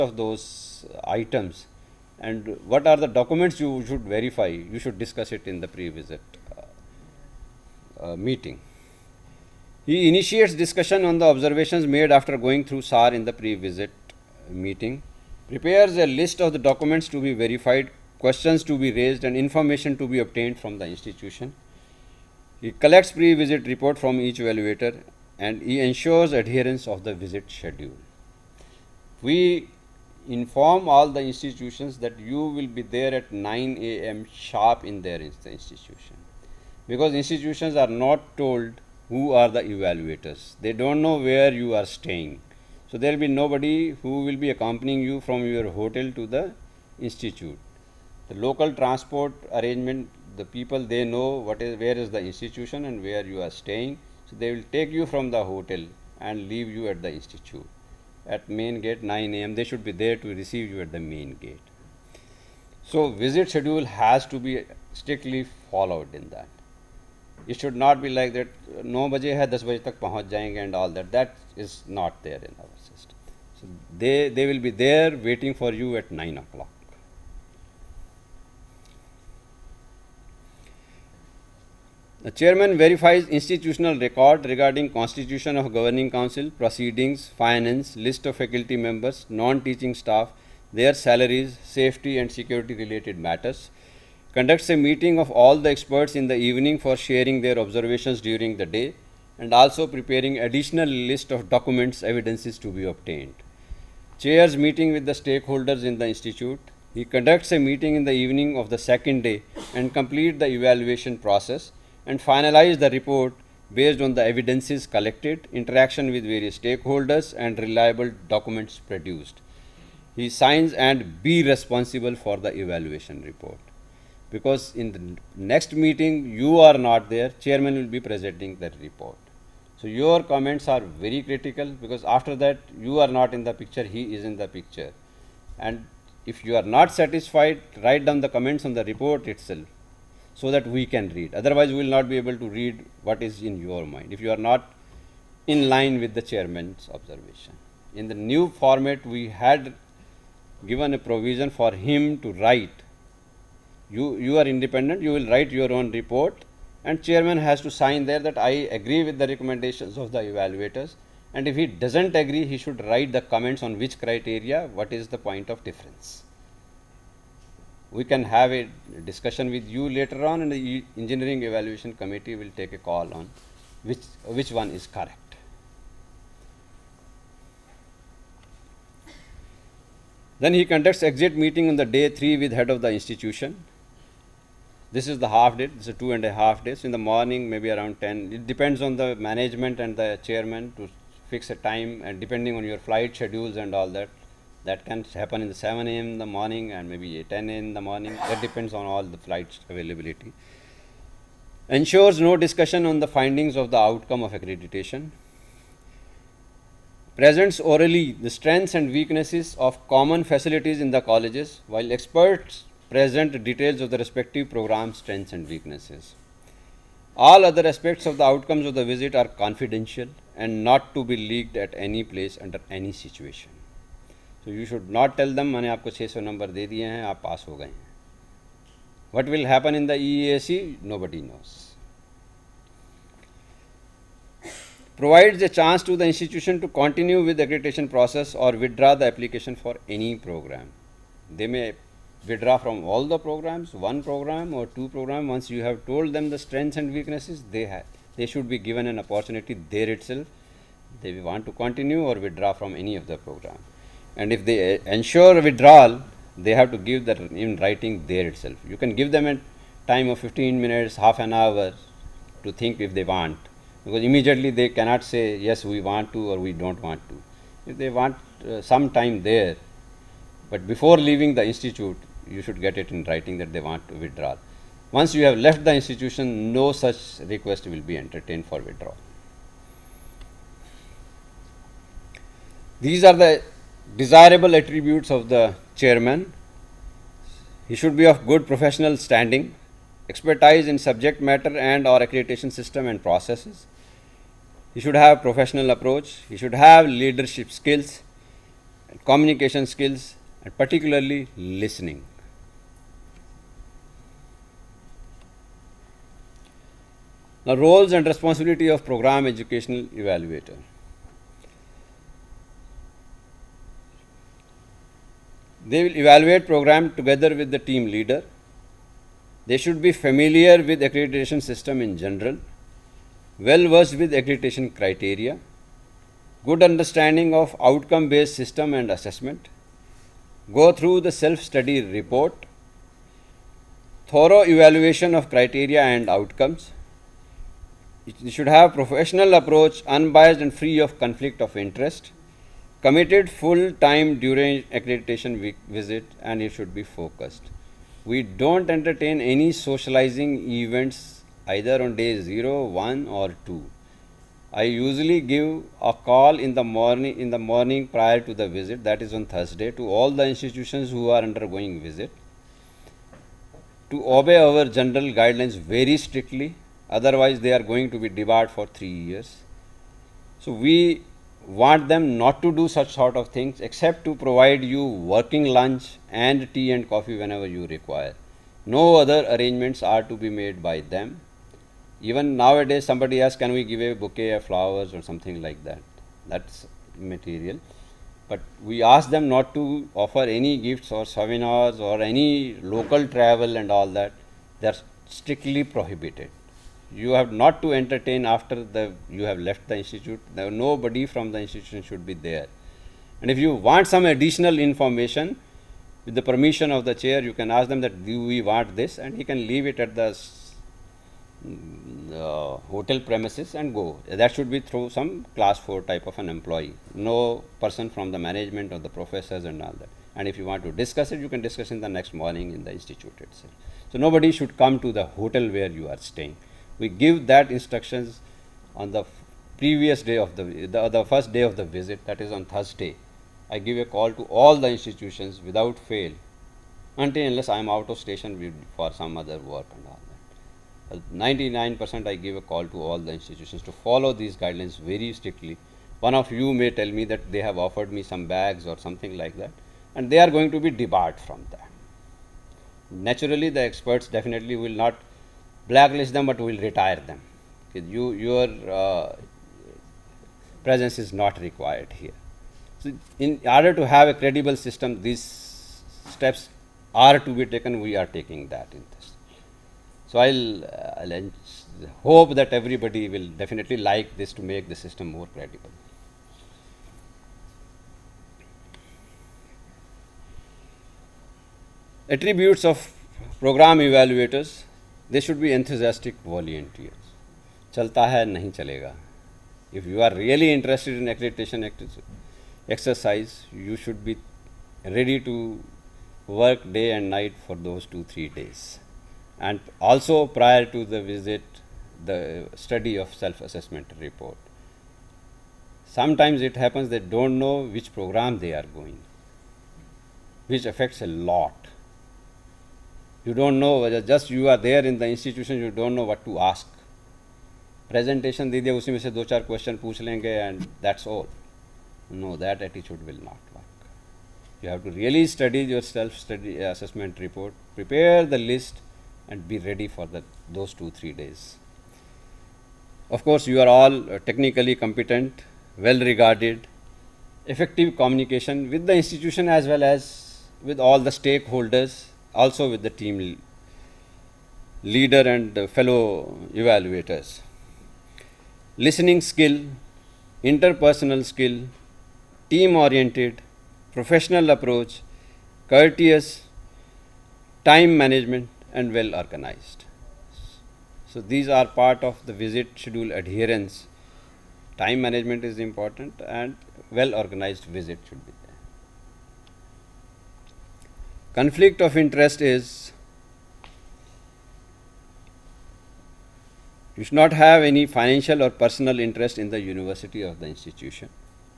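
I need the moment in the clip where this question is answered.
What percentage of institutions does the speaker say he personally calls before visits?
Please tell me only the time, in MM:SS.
07:21.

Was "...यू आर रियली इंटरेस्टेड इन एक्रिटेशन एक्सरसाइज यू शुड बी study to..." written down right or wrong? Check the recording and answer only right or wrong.
wrong.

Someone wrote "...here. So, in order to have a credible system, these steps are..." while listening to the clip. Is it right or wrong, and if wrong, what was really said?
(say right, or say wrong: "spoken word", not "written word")
right.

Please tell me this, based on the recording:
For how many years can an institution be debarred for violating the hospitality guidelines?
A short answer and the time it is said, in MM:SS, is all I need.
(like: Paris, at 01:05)
3, at 06:08.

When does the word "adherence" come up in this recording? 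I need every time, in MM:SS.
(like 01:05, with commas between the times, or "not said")
00:26, 09:23.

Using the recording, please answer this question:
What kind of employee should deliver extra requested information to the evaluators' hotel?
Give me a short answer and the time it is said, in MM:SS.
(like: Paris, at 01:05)
Class 4 employee, at 06:55.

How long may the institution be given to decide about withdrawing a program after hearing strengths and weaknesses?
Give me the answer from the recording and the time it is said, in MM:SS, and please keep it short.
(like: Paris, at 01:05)
15 minutes to half an hour, at 04:20.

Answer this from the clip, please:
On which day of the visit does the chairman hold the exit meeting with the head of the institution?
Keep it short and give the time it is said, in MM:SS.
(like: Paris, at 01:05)
Day 3, at 03:01.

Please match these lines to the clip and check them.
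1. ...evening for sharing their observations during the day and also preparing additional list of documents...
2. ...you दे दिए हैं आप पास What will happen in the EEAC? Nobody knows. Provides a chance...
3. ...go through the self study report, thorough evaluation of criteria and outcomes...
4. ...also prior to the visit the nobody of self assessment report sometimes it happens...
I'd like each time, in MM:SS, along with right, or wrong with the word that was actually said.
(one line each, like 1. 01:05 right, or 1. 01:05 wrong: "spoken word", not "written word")
1. 01:36 right
2. 03:46 right
3. 05:30 right
4. 08:19 wrong: "study", not "nobody".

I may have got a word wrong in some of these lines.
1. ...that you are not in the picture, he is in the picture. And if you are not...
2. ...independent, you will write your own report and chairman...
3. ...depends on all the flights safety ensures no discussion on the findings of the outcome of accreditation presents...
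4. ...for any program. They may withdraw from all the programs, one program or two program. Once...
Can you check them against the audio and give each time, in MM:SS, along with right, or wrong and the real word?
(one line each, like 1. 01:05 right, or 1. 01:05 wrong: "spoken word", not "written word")
1. 02:12 right
2. 02:34 right
3. 03:18 wrong: "availability", not "safety"
4. 03:59 right.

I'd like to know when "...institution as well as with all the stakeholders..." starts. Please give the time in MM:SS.
08:58.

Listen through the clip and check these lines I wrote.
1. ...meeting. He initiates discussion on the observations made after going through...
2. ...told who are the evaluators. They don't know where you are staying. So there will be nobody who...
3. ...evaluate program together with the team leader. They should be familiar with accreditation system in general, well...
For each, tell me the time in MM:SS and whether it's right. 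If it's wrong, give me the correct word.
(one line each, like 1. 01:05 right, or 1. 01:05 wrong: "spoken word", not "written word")
1. 00:08 right
2. 00:38 right
3. 05:15 right.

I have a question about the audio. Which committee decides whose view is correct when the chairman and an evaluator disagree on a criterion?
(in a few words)
Engineering evaluation committee.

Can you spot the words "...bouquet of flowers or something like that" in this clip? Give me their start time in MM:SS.
06:23.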